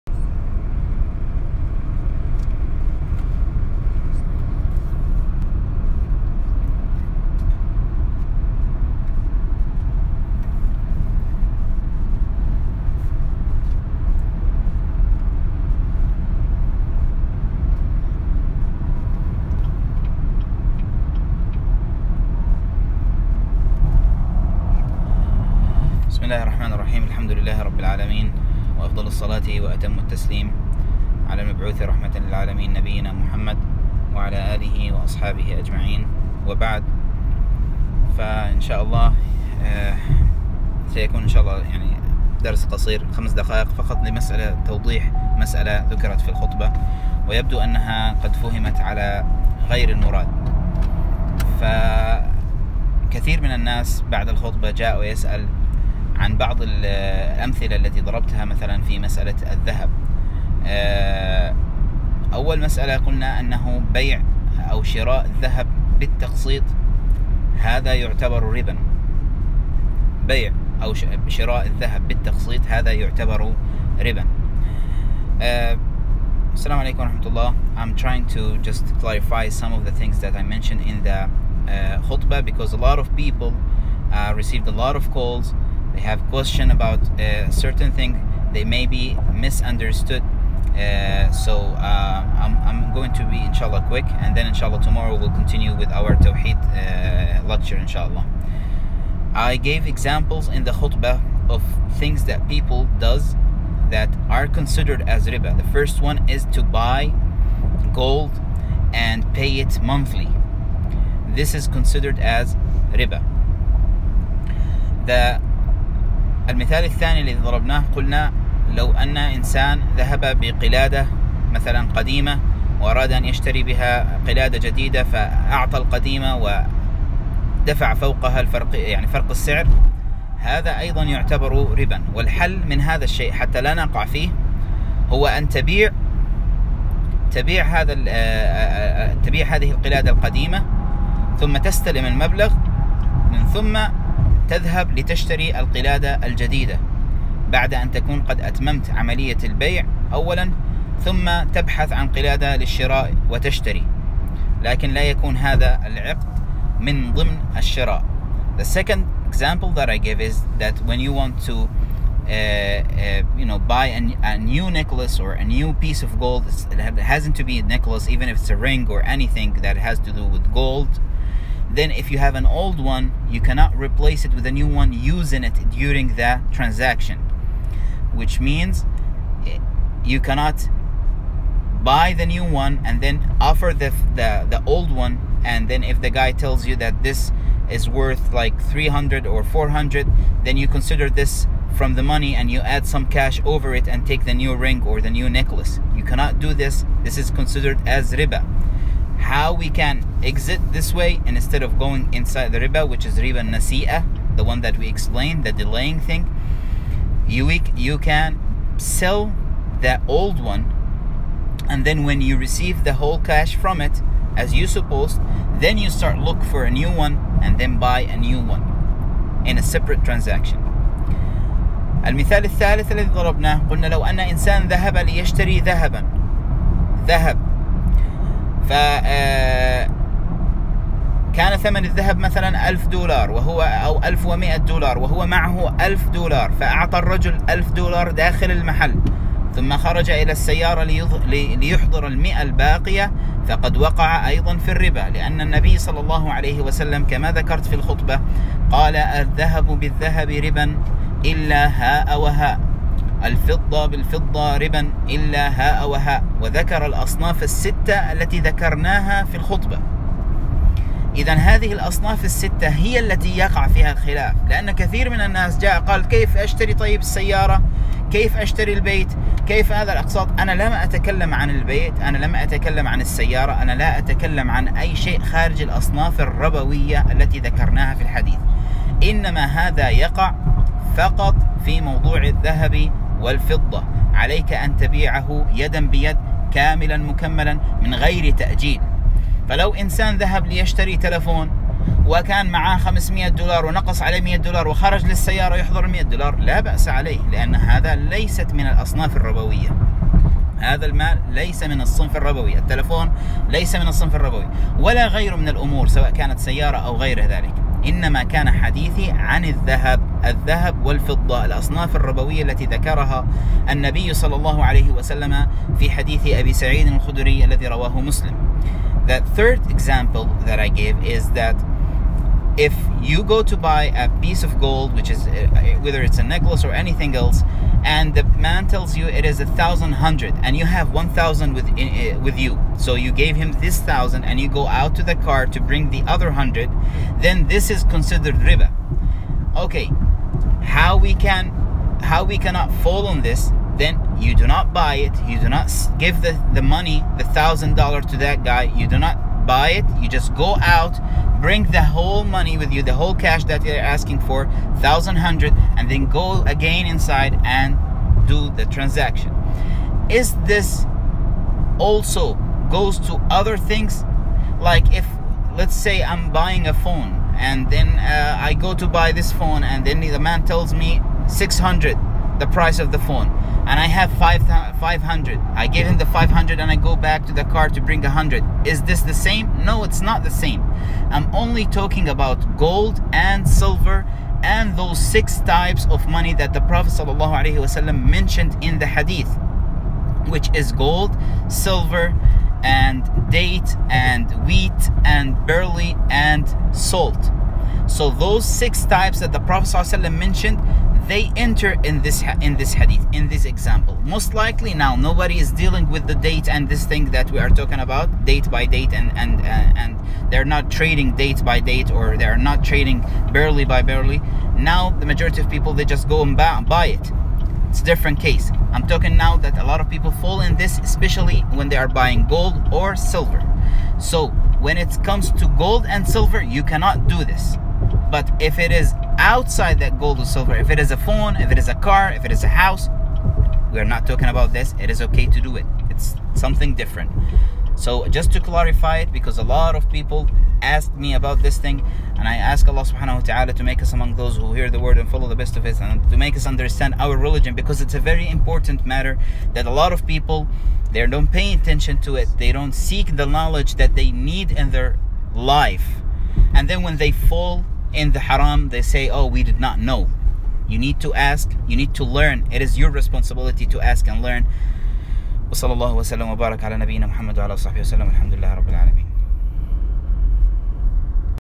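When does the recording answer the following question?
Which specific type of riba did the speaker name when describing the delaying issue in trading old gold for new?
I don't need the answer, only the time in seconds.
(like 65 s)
203 s.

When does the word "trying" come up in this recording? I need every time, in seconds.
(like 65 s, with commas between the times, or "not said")
78 s.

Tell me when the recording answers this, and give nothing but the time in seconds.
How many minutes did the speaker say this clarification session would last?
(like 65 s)
43 s.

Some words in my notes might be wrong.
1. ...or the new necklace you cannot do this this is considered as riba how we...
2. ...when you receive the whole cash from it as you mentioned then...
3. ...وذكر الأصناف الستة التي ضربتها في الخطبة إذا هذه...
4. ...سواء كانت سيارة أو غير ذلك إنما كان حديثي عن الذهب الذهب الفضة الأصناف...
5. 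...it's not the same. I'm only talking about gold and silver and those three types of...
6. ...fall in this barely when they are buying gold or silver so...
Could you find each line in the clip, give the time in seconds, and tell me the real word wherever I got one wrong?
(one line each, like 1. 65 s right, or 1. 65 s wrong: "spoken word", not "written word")
1. 194 s right
2. 212 s wrong: "supposed", not "mentioned"
3. 256 s wrong: "ذكرناها", not "ضربتها"
4. 305 s wrong: "والفضة", not "الفضة"
5. 379 s wrong: "six", not "three"
6. 420 s wrong: "especially", not "barely".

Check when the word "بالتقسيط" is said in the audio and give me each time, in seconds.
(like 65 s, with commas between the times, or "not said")
65 s, 72 s.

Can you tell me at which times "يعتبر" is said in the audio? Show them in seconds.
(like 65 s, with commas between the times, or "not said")
67 s, 72 s, 131 s.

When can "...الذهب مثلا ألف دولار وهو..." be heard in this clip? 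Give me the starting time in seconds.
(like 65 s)
231 s.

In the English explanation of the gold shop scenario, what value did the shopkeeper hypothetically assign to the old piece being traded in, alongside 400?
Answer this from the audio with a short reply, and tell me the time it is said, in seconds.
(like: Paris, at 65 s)
300, at 188 s.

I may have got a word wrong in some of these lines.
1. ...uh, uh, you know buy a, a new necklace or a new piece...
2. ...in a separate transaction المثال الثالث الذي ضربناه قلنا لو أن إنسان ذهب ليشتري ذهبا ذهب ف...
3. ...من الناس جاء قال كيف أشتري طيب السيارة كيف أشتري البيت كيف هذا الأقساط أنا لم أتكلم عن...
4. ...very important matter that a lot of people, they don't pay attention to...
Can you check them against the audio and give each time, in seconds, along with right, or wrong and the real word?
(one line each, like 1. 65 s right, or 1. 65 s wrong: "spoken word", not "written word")
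1. 161 s right
2. 219 s right
3. 265 s right
4. 448 s right.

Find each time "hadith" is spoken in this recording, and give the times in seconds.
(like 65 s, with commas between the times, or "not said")
388 s, 402 s.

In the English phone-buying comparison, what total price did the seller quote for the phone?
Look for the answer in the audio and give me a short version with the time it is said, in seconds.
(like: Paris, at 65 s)
600, at 371 s.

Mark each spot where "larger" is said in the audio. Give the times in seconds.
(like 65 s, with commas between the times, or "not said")
not said.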